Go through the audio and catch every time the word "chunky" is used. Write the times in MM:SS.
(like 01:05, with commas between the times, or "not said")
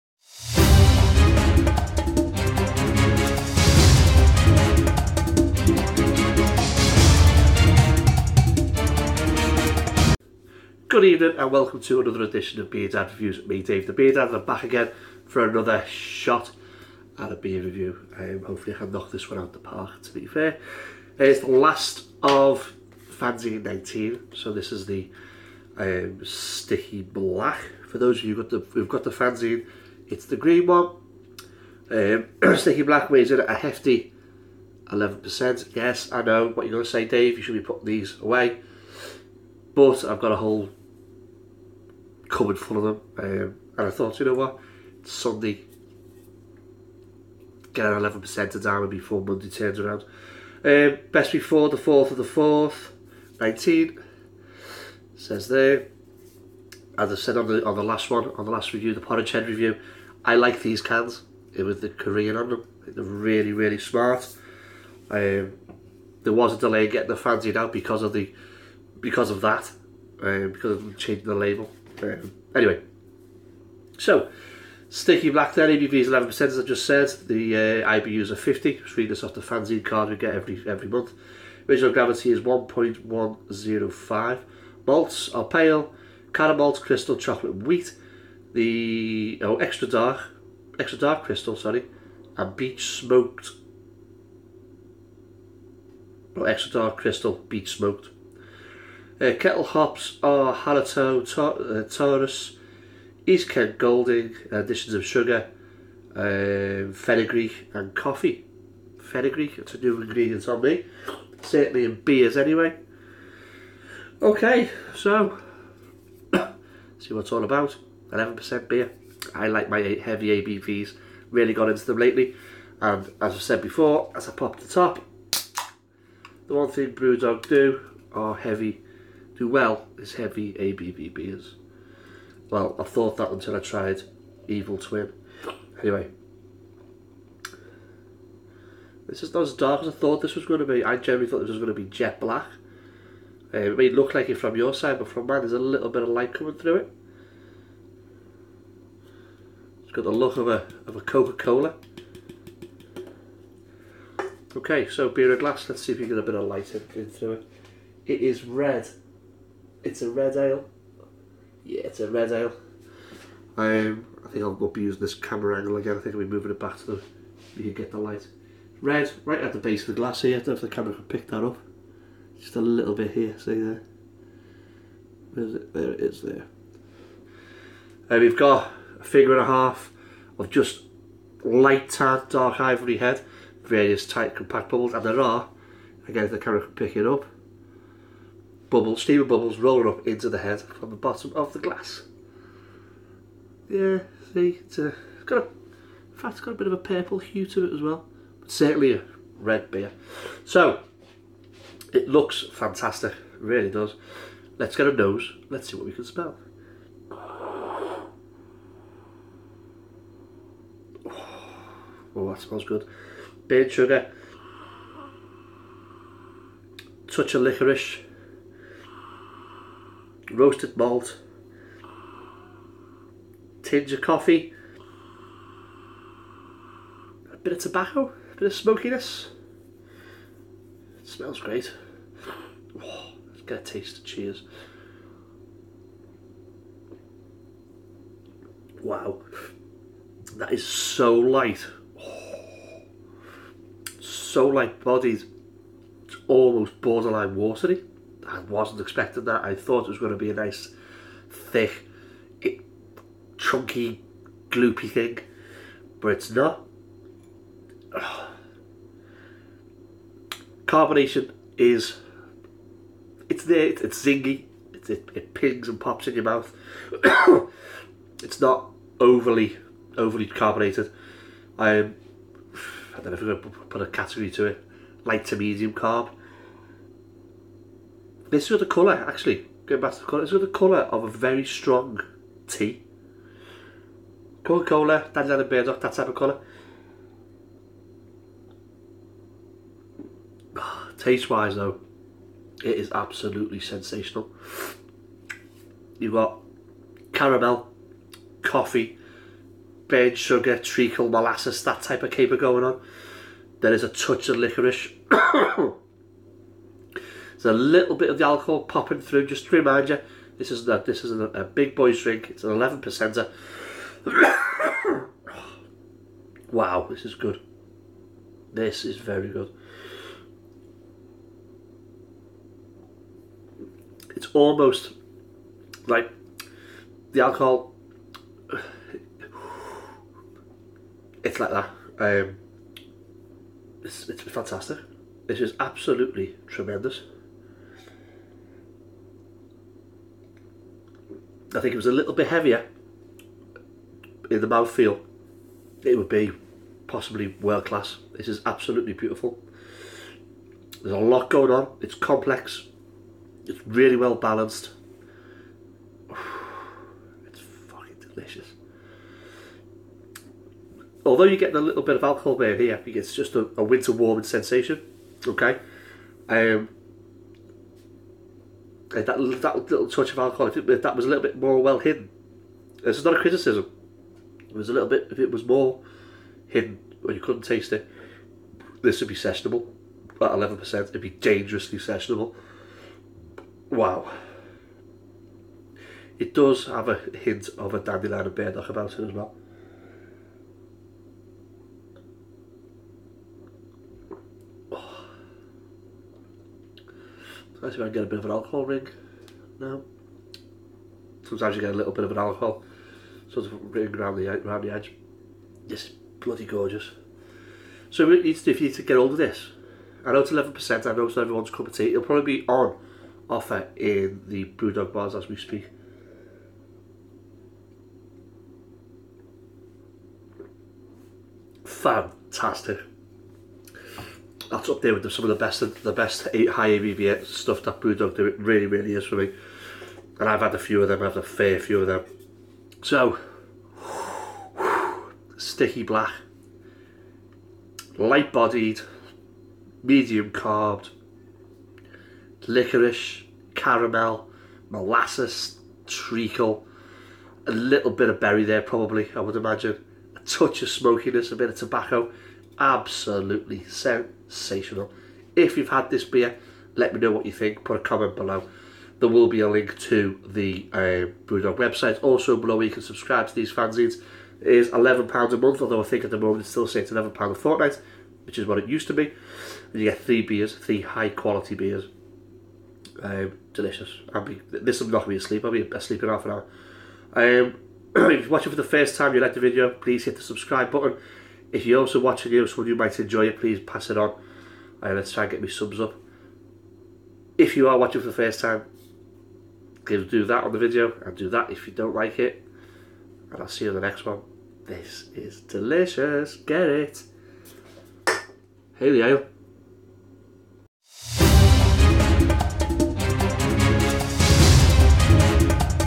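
04:13.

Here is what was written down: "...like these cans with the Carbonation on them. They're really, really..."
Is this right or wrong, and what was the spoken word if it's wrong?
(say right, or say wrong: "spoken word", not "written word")
wrong: "Korean", not "Carbonation".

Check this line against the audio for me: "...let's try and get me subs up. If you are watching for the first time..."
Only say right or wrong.
right.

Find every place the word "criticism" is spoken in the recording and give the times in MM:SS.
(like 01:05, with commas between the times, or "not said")
06:13.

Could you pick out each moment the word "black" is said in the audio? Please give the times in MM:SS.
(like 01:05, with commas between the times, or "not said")
00:27, 00:32, 01:15, 02:22, 07:15.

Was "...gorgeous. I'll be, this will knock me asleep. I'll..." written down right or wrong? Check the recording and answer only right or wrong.
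wrong.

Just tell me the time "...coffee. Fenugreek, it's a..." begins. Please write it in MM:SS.
01:47.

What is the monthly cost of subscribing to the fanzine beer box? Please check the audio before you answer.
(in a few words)
£11.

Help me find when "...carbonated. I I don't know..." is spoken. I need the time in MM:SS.
04:30.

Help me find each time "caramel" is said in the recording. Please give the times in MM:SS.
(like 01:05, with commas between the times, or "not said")
01:26, 04:57, 07:23.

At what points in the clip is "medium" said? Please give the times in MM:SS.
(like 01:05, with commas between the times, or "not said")
04:35, 07:19.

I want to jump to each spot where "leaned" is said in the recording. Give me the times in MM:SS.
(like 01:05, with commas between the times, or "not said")
not said.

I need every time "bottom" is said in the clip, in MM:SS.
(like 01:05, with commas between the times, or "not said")
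03:10.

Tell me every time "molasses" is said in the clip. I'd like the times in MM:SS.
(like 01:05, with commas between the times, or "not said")
05:01, 07:24.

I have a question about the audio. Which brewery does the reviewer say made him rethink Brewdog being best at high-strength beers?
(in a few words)
Evil Twin.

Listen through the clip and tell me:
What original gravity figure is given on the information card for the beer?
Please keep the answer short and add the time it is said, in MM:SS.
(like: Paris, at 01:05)
1.105, at 01:22.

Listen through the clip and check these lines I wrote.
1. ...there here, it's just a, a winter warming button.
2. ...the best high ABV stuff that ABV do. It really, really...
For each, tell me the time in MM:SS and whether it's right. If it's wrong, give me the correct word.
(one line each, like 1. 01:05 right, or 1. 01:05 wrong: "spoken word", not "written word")
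1. 06:02 wrong: "sensation", not "button"
2. 07:05 wrong: "Brewdog", not "ABV".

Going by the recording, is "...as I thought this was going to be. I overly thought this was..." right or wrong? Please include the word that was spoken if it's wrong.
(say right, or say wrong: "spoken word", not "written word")
wrong: "generally", not "overly".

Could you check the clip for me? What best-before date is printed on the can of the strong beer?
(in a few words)
4th of the 4th, 19.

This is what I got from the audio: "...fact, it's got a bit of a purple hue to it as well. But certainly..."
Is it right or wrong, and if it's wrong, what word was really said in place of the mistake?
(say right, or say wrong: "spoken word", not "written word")
right.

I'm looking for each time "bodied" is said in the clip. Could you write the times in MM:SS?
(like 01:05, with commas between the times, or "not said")
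04:04, 07:18.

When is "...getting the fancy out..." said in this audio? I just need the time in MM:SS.
01:06.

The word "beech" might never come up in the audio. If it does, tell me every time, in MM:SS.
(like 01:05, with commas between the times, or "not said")
01:32, 01:37.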